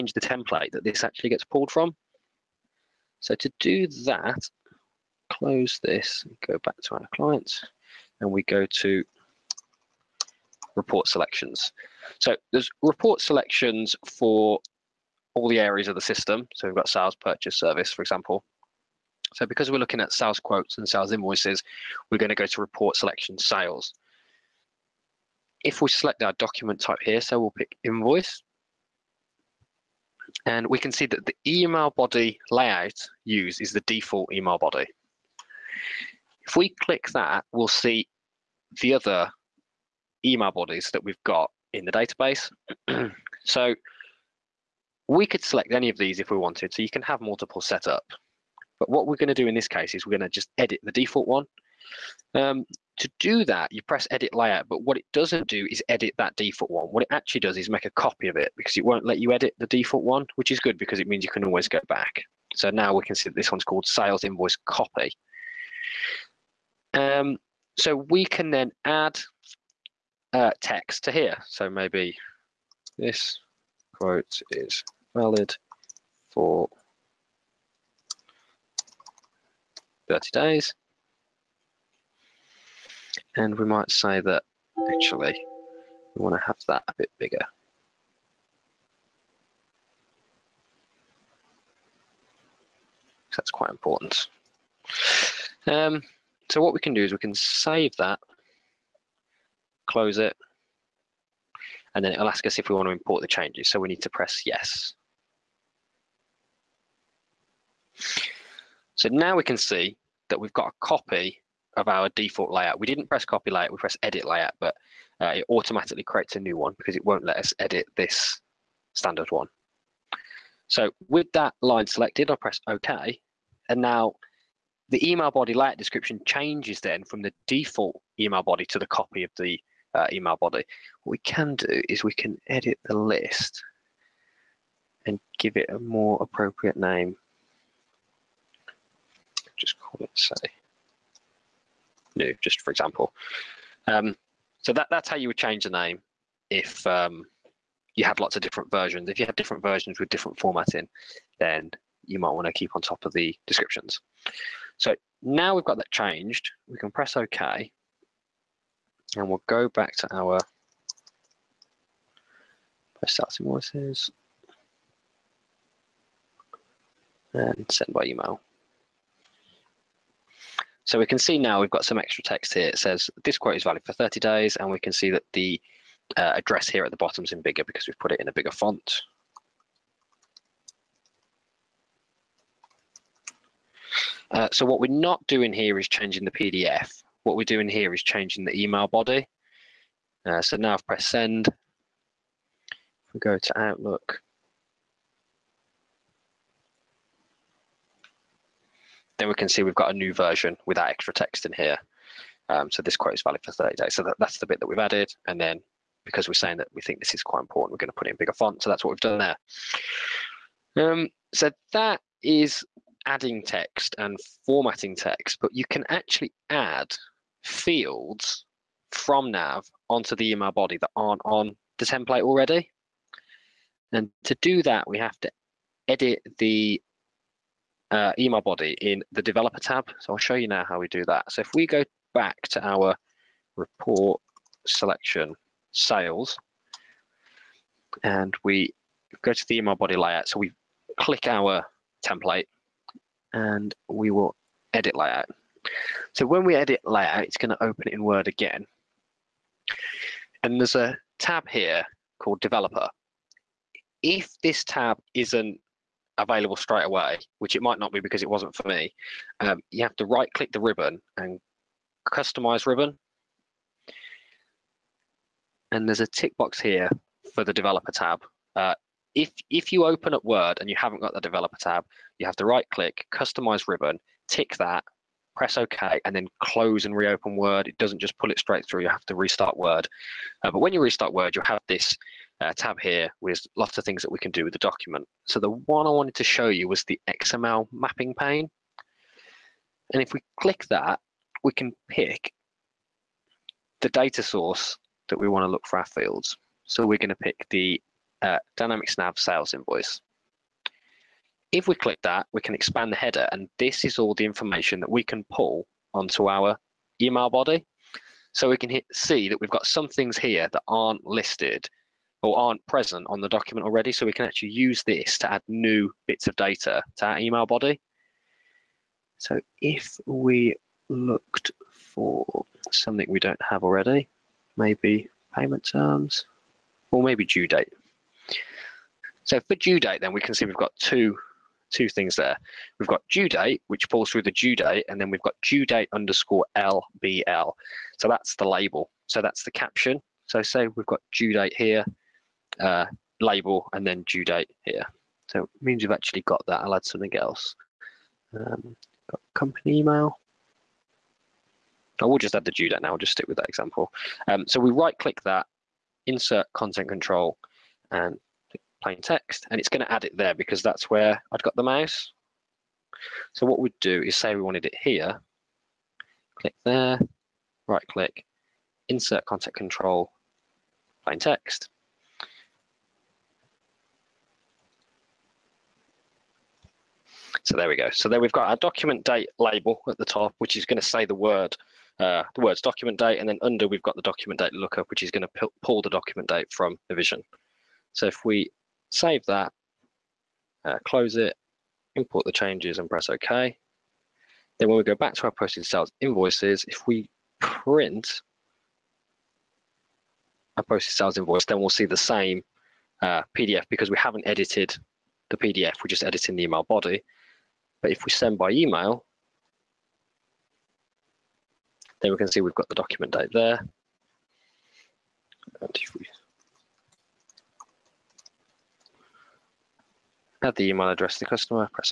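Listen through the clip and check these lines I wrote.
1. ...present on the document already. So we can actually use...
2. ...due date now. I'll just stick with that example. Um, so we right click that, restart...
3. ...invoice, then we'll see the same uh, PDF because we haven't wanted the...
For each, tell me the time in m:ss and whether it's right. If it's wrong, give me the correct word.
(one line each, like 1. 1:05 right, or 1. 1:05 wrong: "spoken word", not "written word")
1. 5:12 right
2. 5:52 wrong: "insert", not "restart"
3. 6:41 wrong: "edited", not "wanted".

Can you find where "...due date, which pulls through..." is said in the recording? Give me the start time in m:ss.
5:33.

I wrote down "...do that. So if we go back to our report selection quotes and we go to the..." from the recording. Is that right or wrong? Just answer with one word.
wrong.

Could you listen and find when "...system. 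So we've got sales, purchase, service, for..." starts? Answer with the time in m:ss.
0:16.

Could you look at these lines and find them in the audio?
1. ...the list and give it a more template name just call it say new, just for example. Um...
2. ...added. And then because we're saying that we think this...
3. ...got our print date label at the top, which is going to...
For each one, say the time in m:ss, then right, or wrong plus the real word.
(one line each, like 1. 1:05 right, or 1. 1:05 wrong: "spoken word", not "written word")
1. 2:12 wrong: "appropriate", not "template"
2. 3:24 right
3. 6:18 wrong: "document", not "print".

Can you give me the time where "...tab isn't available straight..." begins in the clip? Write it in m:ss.
4:14.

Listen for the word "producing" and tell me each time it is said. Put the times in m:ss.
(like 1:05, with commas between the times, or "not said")
not said.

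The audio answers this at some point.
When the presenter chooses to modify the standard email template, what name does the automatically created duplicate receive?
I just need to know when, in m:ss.
1:03.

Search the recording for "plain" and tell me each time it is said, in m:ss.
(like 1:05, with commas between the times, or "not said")
5:58, 6:11.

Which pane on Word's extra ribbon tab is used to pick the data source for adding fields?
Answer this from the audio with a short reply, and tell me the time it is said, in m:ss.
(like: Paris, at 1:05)
XML mapping pane, at 4:47.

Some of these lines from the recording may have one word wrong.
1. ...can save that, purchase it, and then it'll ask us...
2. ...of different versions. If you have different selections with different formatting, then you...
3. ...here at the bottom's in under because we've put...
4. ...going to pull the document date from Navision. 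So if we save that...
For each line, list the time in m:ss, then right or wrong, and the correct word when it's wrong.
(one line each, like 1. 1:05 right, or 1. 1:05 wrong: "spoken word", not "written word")
1. 1:37 wrong: "close", not "purchase"
2. 2:28 wrong: "versions", not "selections"
3. 2:56 wrong: "bigger", not "under"
4. 6:25 right.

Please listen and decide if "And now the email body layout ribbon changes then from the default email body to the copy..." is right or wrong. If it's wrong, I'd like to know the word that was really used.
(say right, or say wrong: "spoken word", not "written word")
wrong: "description", not "ribbon".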